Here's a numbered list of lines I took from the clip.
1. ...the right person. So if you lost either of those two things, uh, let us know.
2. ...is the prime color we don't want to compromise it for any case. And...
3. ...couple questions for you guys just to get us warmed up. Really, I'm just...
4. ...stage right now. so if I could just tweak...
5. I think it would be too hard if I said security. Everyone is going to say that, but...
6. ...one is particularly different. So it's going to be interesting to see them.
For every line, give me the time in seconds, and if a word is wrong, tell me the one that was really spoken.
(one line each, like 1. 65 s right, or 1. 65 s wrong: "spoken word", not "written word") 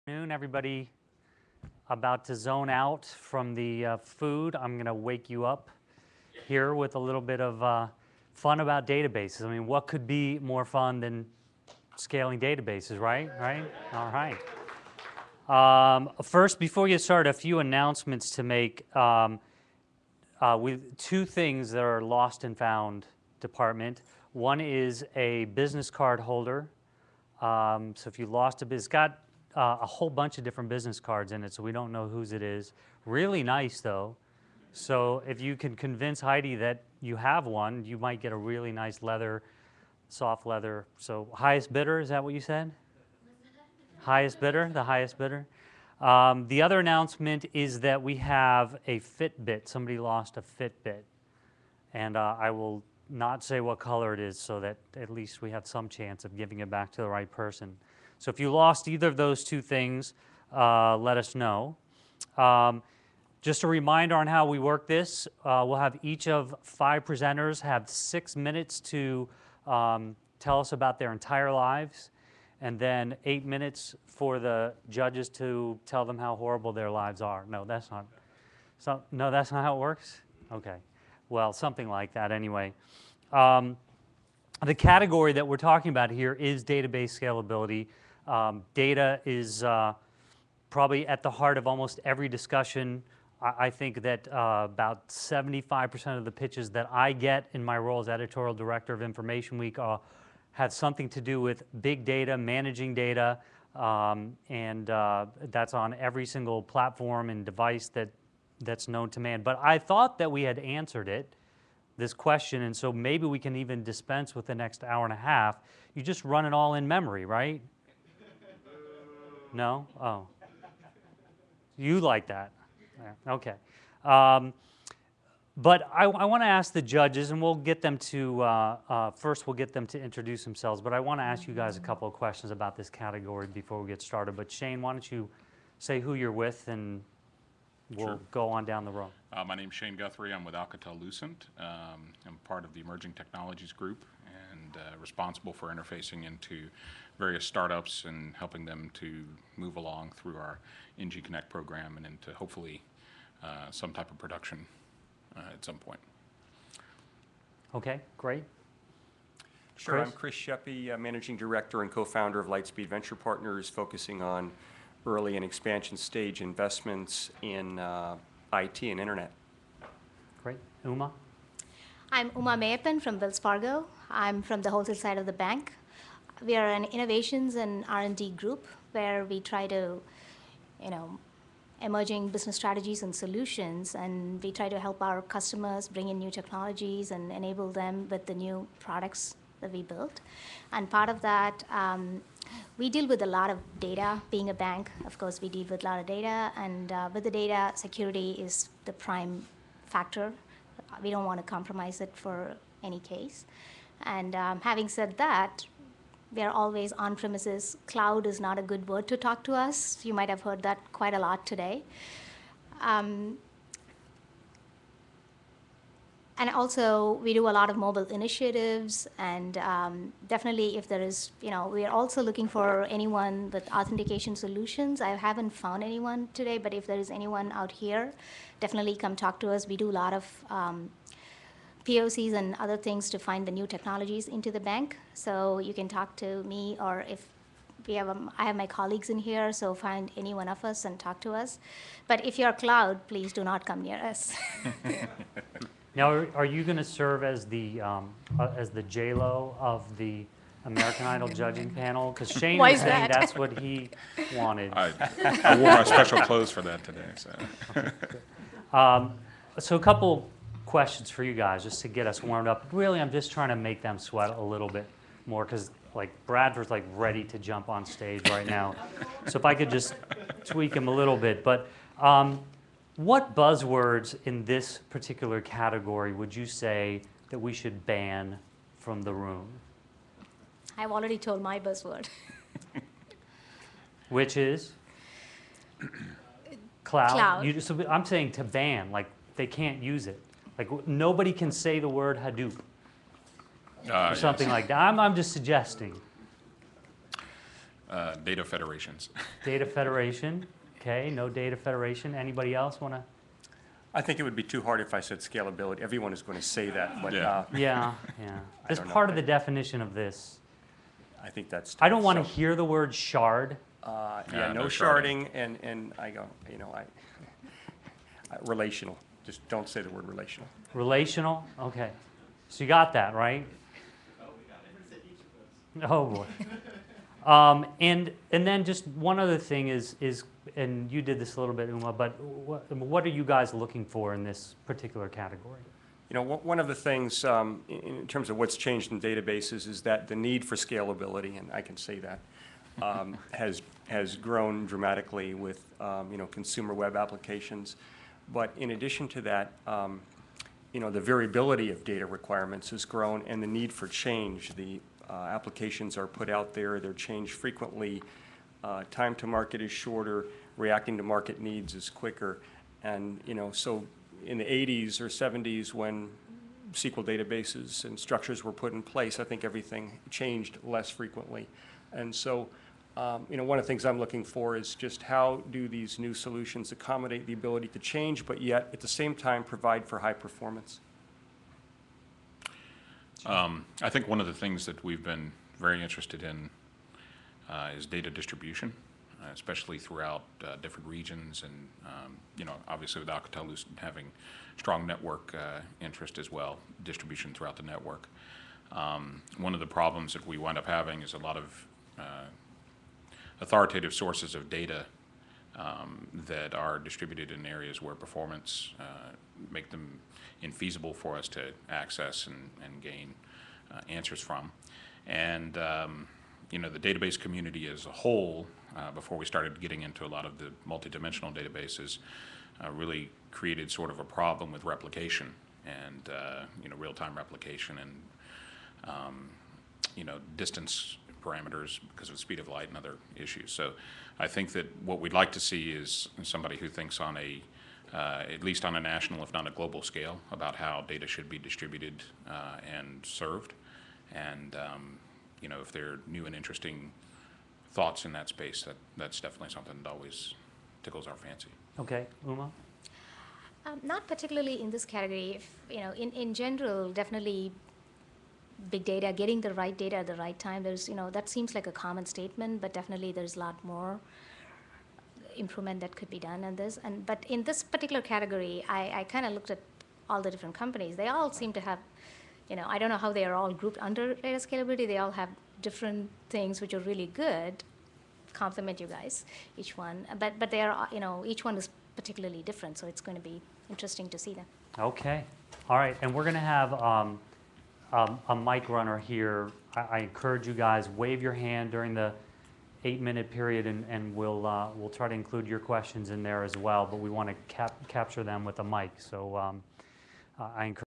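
1. 57 s right
2. 198 s wrong: "factor", not "color"
3. 259 s right
4. 267 s right
5. 303 s wrong: "scalability", not "security"
6. 481 s right.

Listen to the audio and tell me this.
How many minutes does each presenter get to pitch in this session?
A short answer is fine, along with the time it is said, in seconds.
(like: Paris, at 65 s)
6, at 67 s.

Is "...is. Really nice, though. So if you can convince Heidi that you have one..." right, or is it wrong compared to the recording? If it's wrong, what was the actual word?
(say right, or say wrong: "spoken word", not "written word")
right.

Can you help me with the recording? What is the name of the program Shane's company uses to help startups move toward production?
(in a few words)
NG Connect.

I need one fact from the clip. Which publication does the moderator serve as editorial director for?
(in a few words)
Information Week.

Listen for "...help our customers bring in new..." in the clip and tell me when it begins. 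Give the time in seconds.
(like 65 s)
184 s.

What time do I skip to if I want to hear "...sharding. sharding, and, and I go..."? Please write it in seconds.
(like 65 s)
314 s.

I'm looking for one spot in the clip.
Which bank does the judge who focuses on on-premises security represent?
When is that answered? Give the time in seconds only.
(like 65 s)
173 s.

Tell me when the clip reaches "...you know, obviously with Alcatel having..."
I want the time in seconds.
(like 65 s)
392 s.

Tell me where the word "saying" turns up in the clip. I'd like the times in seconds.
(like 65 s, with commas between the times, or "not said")
252 s, 288 s.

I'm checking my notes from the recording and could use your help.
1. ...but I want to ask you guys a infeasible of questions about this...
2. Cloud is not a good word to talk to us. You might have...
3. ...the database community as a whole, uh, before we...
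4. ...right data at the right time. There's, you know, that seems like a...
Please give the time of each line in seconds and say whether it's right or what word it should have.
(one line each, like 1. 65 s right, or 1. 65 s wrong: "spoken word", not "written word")
1. 130 s wrong: "couple", not "infeasible"
2. 207 s right
3. 416 s right
4. 459 s right.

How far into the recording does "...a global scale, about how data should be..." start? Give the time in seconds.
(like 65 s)
439 s.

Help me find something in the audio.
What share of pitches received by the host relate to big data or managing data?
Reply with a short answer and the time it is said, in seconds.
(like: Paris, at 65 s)
75%, at 95 s.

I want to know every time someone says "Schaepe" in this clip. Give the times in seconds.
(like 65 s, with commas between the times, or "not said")
160 s.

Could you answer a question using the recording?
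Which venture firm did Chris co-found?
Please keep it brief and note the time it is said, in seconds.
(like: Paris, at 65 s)
Lightspeed Venture Partners, at 162 s.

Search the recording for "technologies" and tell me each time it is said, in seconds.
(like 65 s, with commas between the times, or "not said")
143 s, 186 s, 233 s.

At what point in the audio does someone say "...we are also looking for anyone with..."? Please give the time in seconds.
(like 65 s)
221 s.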